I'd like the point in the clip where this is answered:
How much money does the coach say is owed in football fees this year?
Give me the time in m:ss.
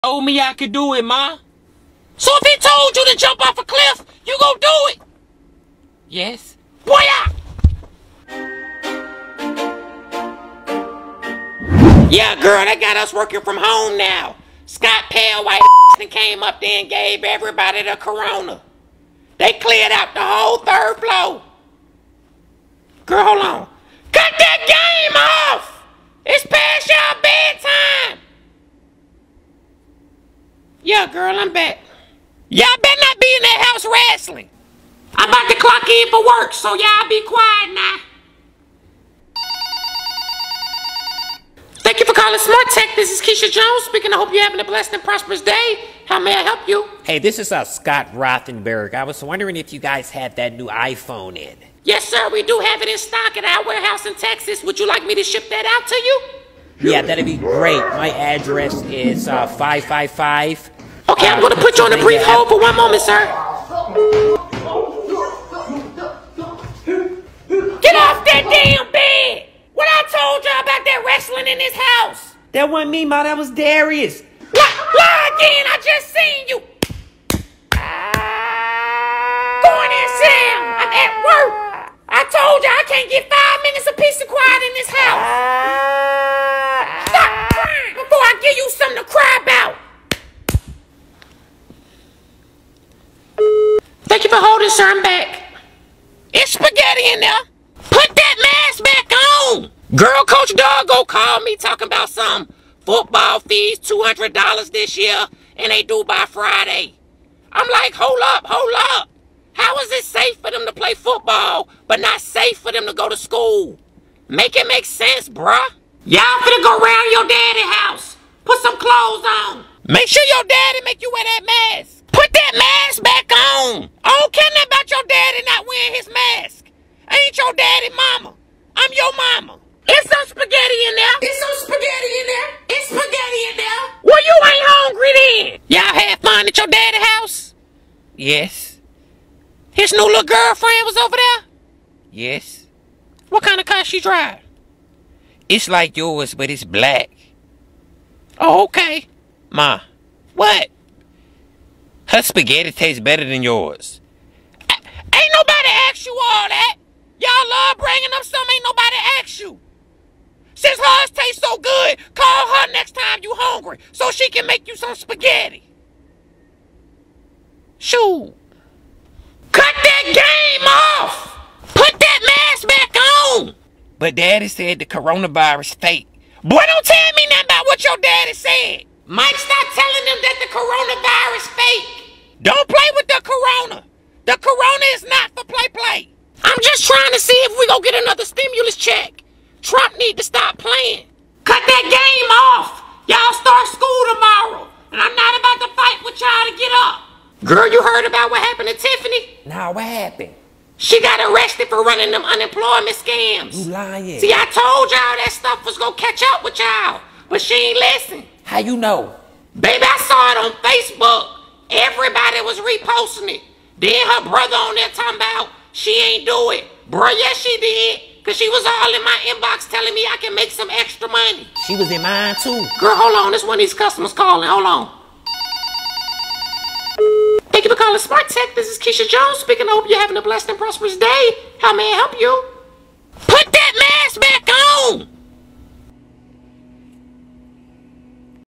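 1:43.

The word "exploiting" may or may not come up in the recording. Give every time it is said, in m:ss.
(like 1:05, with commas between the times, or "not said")
not said.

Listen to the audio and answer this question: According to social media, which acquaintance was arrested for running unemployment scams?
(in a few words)
Tiffany.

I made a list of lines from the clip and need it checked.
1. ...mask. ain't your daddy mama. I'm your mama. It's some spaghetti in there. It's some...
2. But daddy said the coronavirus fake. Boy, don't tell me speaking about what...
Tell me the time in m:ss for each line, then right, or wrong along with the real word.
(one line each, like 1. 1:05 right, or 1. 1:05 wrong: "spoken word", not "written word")
1. 2:06 right
2. 2:53 wrong: "nothing", not "speaking".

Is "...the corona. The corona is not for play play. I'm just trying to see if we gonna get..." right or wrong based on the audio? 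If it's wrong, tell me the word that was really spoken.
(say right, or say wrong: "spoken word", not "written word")
right.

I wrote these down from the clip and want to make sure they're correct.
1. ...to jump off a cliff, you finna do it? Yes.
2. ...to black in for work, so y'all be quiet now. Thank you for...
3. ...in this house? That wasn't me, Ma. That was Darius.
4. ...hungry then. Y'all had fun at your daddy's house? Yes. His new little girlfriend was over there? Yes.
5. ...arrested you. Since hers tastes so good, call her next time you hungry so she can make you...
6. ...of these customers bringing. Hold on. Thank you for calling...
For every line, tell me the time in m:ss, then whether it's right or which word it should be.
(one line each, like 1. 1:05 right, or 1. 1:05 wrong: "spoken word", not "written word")
1. 0:03 wrong: "gonna", not "finna"
2. 0:35 wrong: "clock", not "black"
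3. 1:11 right
4. 2:14 right
5. 2:39 wrong: "asked", not "arrested"
6. 3:43 wrong: "calling", not "bringing".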